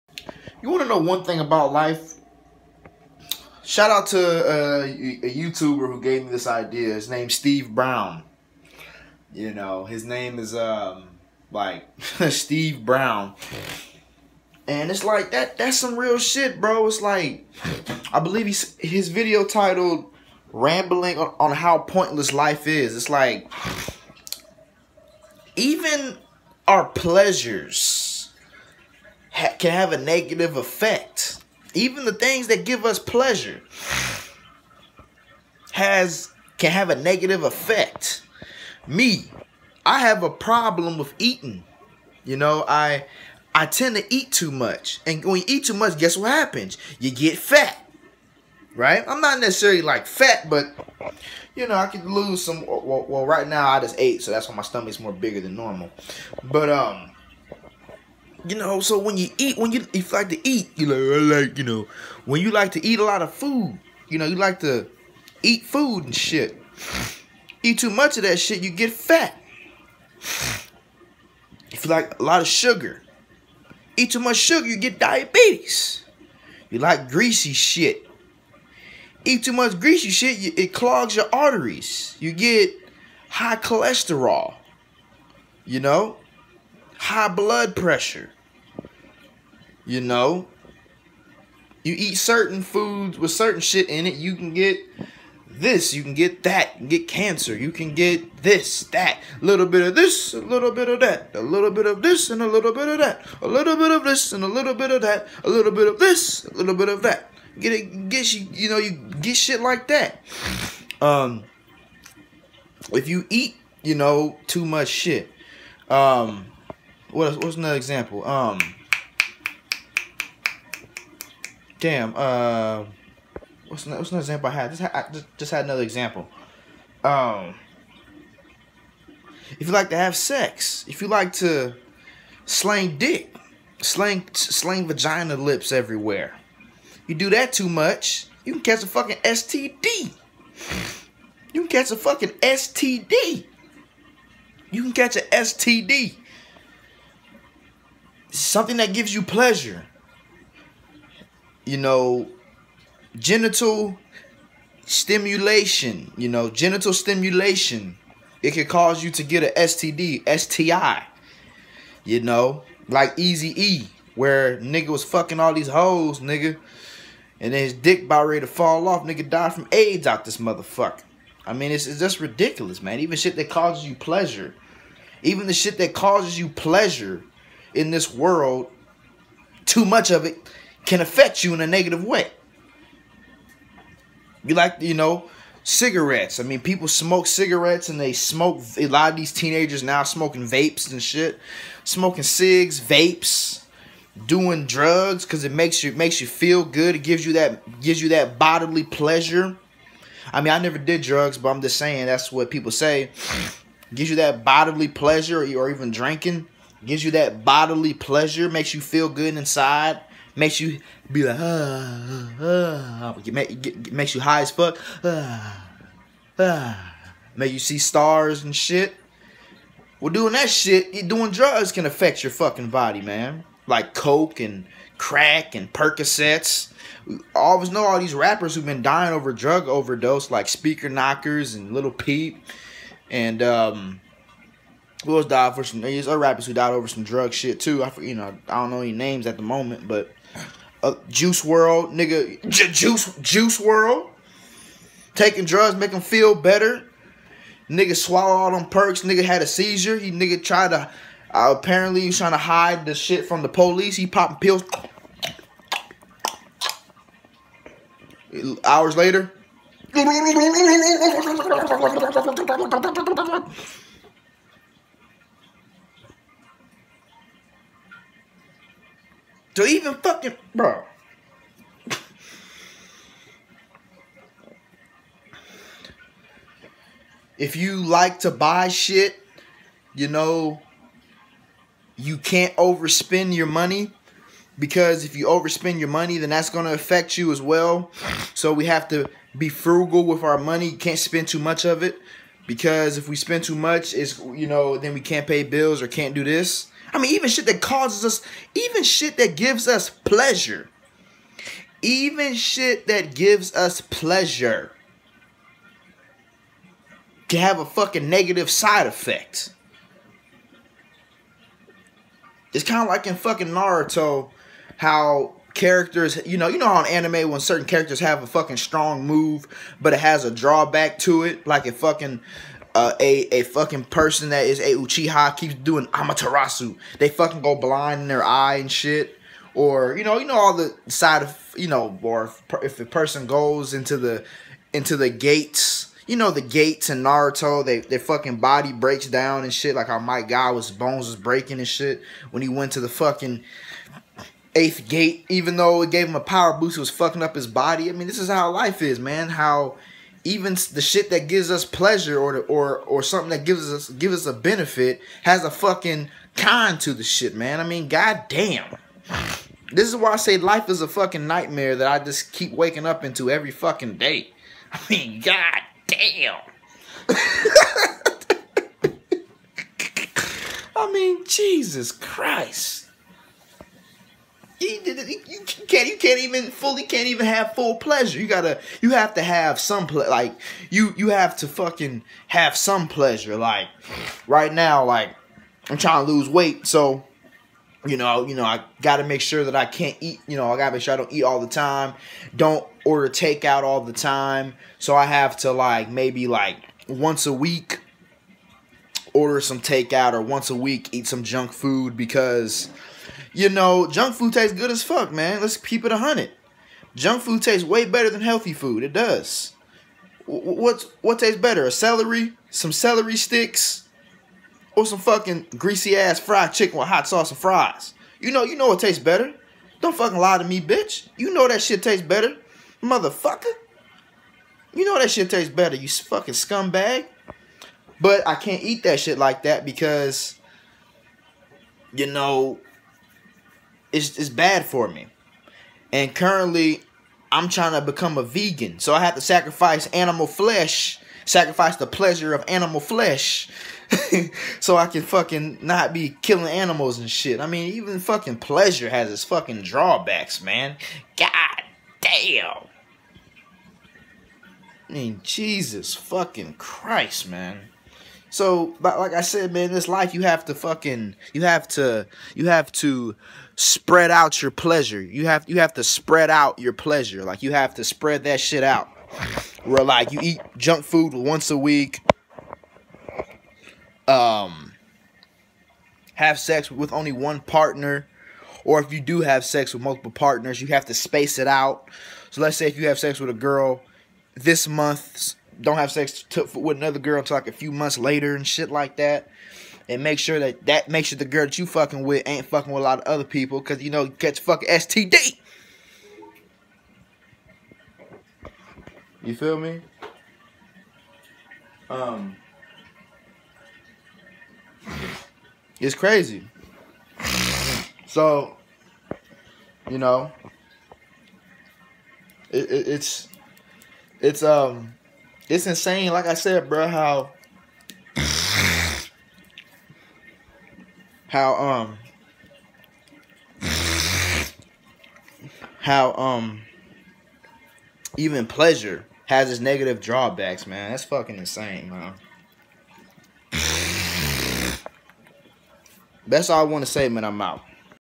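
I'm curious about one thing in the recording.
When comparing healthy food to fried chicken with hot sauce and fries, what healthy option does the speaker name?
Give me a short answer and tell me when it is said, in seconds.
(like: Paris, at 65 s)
celery sticks, at 412 s.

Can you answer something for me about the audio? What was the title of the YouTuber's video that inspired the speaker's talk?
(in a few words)
Rambling on how pointless life is.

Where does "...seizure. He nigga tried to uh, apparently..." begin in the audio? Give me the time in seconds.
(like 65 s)
249 s.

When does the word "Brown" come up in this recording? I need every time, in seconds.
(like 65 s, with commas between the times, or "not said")
7 s, 12 s.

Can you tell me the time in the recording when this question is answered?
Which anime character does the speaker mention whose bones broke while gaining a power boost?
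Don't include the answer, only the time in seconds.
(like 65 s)
339 s.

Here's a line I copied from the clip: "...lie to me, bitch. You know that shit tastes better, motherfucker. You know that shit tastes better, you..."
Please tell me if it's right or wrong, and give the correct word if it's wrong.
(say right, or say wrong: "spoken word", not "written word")
right.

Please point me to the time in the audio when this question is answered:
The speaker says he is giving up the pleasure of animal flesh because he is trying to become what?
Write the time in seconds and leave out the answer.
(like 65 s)
438 s.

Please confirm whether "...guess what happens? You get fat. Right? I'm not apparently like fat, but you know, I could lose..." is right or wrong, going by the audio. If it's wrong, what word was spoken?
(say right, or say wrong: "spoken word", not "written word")
wrong: "necessarily", not "apparently".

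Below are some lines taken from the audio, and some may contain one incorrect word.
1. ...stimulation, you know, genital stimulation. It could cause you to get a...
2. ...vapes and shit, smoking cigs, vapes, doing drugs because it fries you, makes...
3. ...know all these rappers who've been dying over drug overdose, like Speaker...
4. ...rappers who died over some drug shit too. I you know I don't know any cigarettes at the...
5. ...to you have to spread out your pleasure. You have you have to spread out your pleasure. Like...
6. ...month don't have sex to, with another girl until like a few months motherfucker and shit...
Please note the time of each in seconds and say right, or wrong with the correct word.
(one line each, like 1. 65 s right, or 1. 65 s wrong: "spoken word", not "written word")
1. 154 s right
2. 190 s wrong: "makes", not "fries"
3. 227 s right
4. 236 s wrong: "names", not "cigarettes"
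5. 461 s right
6. 484 s wrong: "later", not "motherfucker".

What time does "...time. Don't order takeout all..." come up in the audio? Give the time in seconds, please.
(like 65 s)
391 s.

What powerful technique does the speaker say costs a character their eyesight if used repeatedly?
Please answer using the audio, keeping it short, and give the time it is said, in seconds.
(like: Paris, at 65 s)
Amaterasu, at 325 s.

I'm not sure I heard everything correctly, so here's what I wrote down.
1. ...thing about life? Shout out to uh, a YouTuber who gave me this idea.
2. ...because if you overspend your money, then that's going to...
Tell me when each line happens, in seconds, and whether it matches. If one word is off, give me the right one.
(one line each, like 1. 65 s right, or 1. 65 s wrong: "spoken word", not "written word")
1. 1 s right
2. 284 s right.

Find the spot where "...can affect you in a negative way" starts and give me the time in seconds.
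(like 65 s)
180 s.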